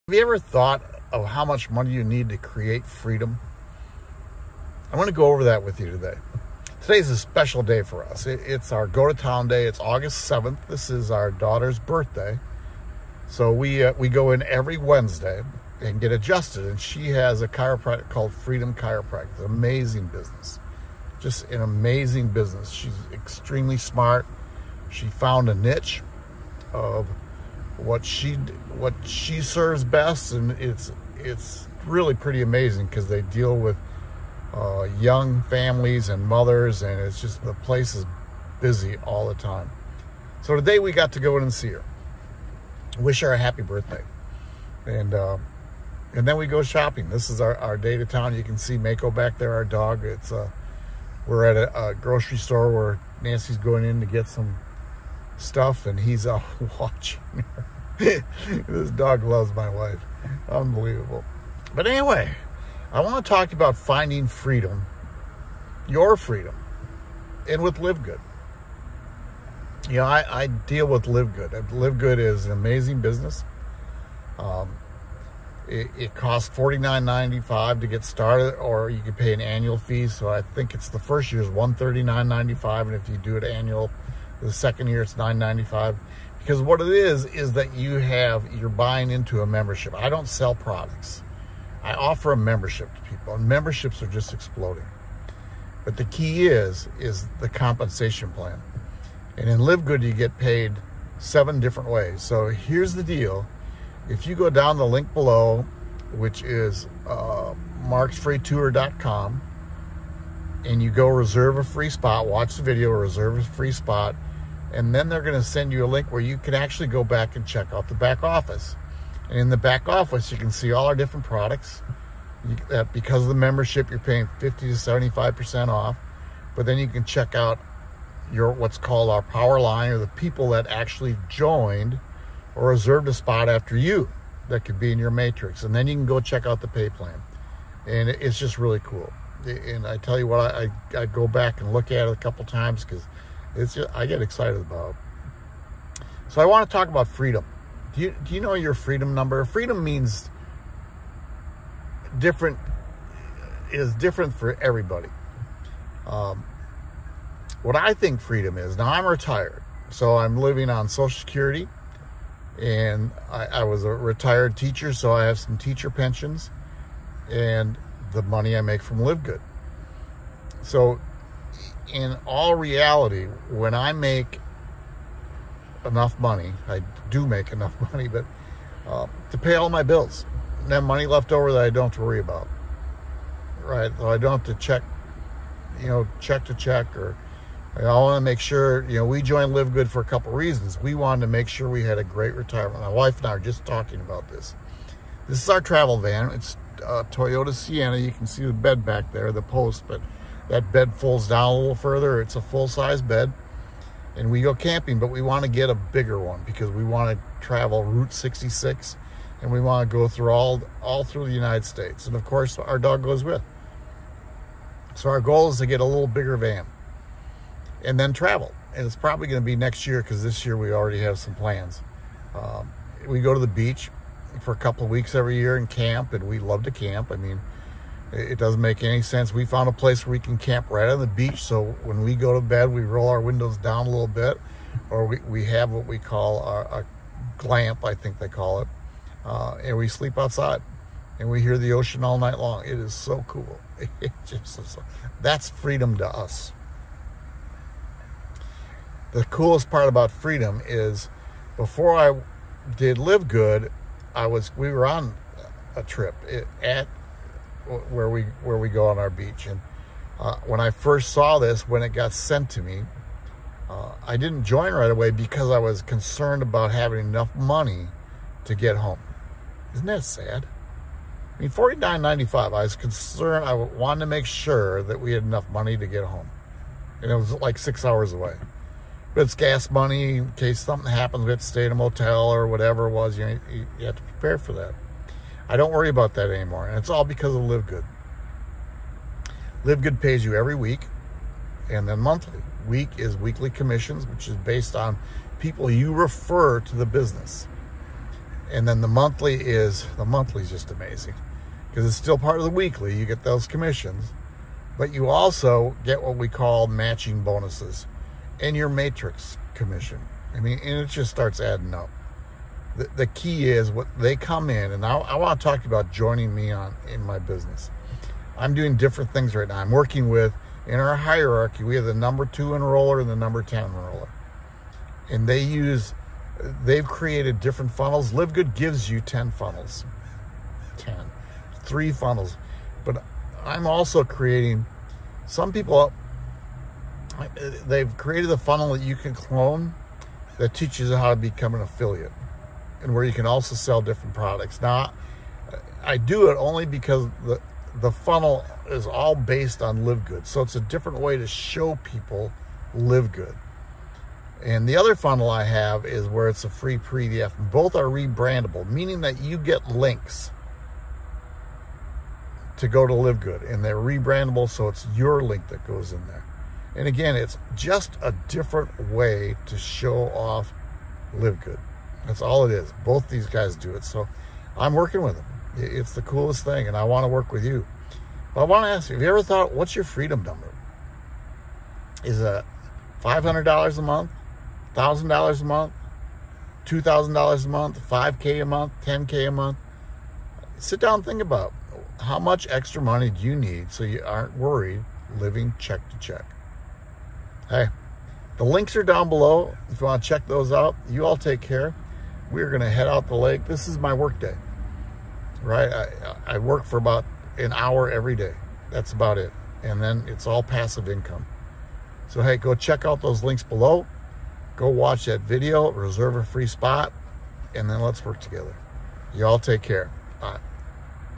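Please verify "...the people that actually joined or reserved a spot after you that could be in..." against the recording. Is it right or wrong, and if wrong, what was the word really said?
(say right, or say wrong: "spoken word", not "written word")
right.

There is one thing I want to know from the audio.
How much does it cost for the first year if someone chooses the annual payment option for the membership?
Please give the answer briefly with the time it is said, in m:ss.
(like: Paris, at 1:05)
$139.95, at 1:21.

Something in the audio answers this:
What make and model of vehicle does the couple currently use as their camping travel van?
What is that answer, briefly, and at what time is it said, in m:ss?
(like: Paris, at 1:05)
Toyota Sienna, at 3:17.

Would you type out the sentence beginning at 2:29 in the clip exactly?
Freedom means different, is different for everybody.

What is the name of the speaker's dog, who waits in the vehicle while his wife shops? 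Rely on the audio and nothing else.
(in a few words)
Mako.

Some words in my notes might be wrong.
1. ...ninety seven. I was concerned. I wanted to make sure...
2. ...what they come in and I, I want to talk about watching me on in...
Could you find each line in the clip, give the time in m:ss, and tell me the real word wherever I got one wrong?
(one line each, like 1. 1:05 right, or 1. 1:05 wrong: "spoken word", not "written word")
1. 4:32 wrong: "five", not "seven"
2. 5:13 wrong: "joining", not "watching".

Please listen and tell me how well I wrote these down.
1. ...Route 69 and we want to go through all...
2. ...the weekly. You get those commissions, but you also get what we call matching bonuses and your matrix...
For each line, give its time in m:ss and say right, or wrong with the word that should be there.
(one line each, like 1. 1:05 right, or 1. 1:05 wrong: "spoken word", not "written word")
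1. 3:27 wrong: "66", not "69"
2. 5:02 right.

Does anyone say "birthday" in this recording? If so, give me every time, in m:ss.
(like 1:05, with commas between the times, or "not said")
0:11, 0:43.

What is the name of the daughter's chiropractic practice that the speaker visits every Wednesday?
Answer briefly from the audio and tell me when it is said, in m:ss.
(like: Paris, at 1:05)
Freedom Chiropractic, at 0:18.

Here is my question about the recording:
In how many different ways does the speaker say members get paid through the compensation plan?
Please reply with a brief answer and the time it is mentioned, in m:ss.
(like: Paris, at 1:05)
7, at 1:41.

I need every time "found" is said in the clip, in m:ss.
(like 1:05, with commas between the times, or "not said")
0:25, 3:49.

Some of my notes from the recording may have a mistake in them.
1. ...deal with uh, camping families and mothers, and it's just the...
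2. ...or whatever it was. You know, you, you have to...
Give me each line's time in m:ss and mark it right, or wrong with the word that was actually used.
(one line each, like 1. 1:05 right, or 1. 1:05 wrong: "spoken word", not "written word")
1. 0:33 wrong: "young", not "camping"
2. 4:42 right.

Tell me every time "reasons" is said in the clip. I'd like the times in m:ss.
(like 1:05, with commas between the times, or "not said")
3:10.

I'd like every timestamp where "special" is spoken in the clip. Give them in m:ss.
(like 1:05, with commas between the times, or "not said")
0:07.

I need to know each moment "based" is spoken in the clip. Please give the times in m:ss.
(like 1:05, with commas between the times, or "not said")
4:54, 5:49.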